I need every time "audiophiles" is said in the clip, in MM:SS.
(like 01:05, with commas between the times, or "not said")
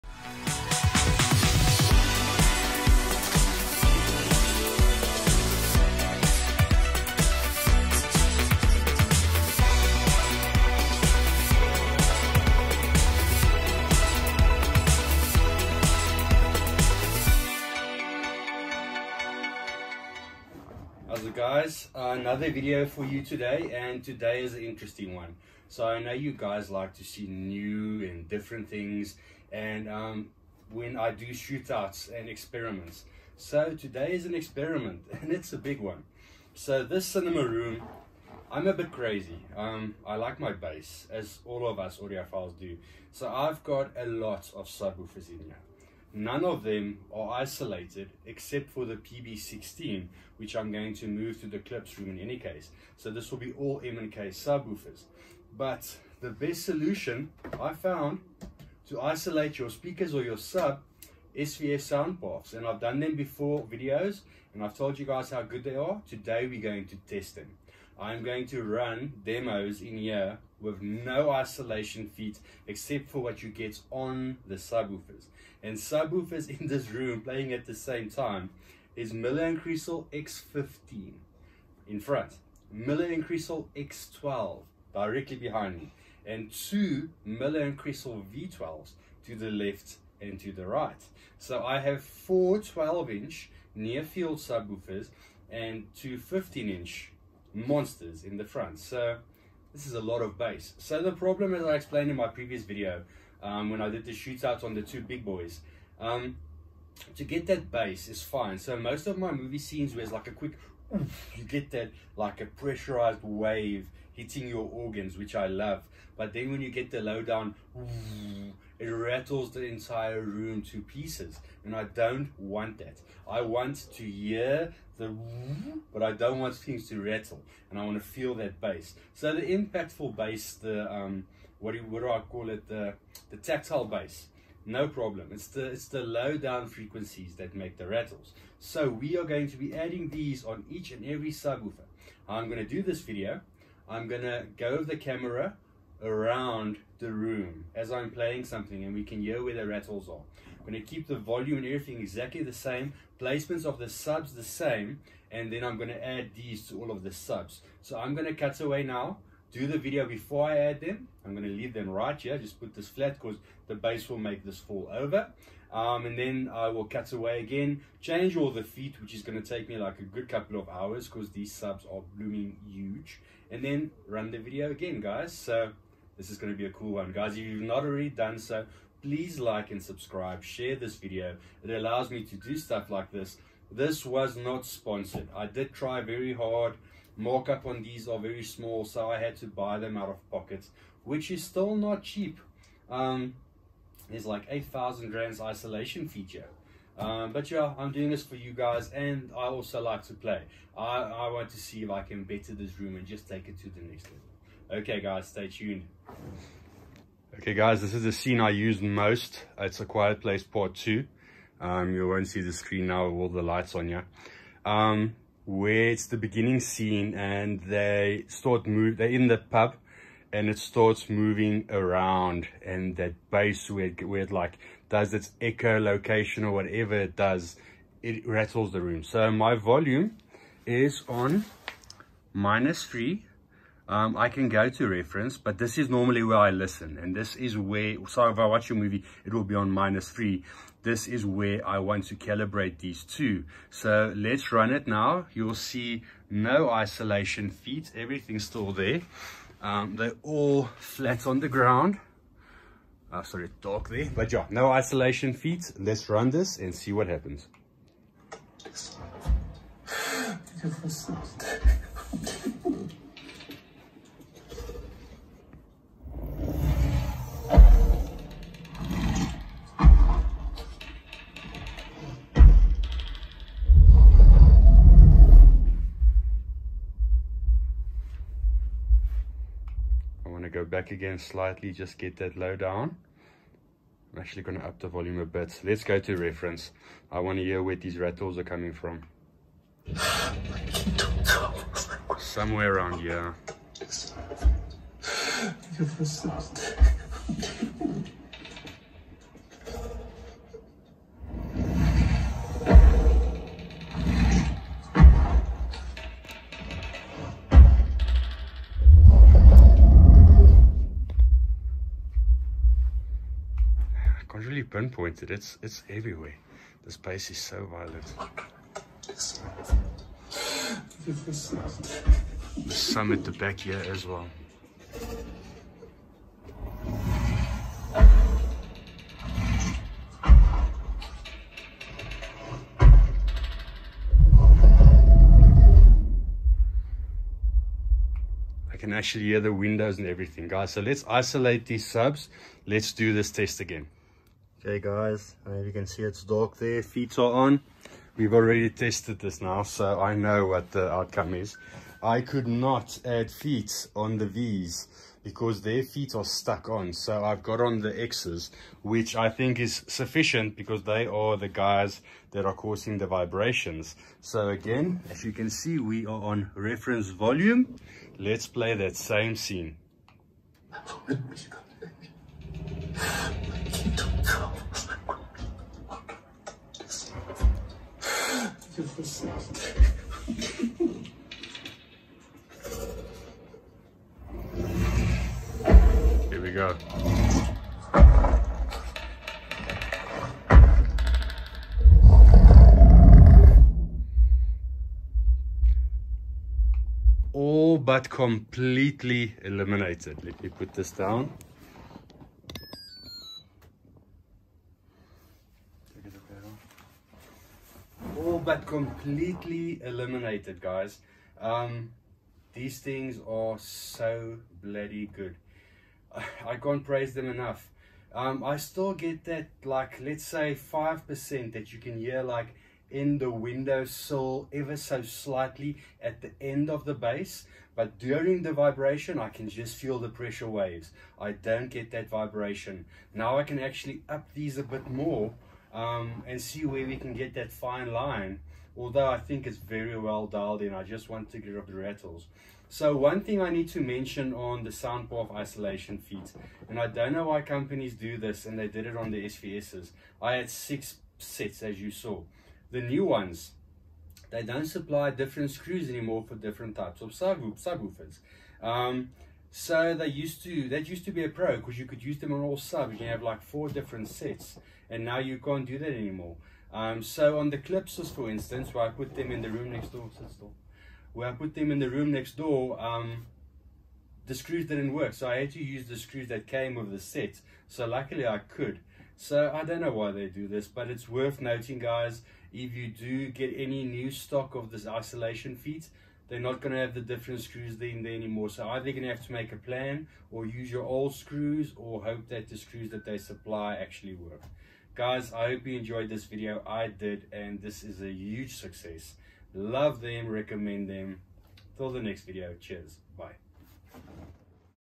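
00:41.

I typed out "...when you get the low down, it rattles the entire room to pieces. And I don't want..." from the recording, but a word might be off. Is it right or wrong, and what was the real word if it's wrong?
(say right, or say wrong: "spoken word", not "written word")
right.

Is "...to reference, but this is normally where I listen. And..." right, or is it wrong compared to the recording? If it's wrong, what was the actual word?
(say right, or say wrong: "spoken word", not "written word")
right.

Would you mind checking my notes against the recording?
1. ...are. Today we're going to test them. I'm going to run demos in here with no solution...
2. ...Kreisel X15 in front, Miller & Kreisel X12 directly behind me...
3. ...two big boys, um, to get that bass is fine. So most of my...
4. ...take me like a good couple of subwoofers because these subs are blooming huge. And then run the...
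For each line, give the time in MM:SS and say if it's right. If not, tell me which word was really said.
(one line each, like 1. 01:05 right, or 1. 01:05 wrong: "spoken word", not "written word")
1. 01:05 wrong: "isolation", not "solution"
2. 01:19 right
3. 01:44 right
4. 02:49 wrong: "hours", not "subwoofers".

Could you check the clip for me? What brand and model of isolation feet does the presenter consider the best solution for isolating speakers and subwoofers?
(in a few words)
SVS SoundPaths.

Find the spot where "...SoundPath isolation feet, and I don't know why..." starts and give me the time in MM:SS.
07:24.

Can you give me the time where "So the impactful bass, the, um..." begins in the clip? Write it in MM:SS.
02:09.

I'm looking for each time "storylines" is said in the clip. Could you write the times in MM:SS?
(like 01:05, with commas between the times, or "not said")
not said.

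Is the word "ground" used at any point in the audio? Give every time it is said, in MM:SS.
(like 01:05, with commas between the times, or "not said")
04:11.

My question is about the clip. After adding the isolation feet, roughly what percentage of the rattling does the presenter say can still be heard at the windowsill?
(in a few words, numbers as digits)
5%.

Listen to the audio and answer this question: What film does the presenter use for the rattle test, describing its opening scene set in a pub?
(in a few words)
A Quiet Place Part Two.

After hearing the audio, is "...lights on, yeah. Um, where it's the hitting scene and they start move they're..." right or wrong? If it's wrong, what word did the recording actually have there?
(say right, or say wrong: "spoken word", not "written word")
wrong: "beginning", not "hitting".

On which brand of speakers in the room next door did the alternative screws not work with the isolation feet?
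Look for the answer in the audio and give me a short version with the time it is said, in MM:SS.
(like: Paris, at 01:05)
Klipsch, at 07:47.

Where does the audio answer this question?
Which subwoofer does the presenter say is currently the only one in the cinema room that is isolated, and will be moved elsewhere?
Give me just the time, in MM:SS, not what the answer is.
00:48.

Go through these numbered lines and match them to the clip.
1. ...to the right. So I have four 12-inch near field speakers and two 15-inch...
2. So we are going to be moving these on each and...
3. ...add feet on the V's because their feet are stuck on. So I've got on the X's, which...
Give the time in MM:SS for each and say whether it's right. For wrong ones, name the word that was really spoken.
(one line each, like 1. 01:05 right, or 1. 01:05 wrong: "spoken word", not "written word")
1. 01:30 wrong: "subwoofers", not "speakers"
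2. 02:18 wrong: "adding", not "moving"
3. 05:53 right.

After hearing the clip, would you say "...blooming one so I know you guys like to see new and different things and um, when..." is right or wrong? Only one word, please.
wrong.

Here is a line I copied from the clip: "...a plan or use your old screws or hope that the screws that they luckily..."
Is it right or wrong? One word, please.
wrong.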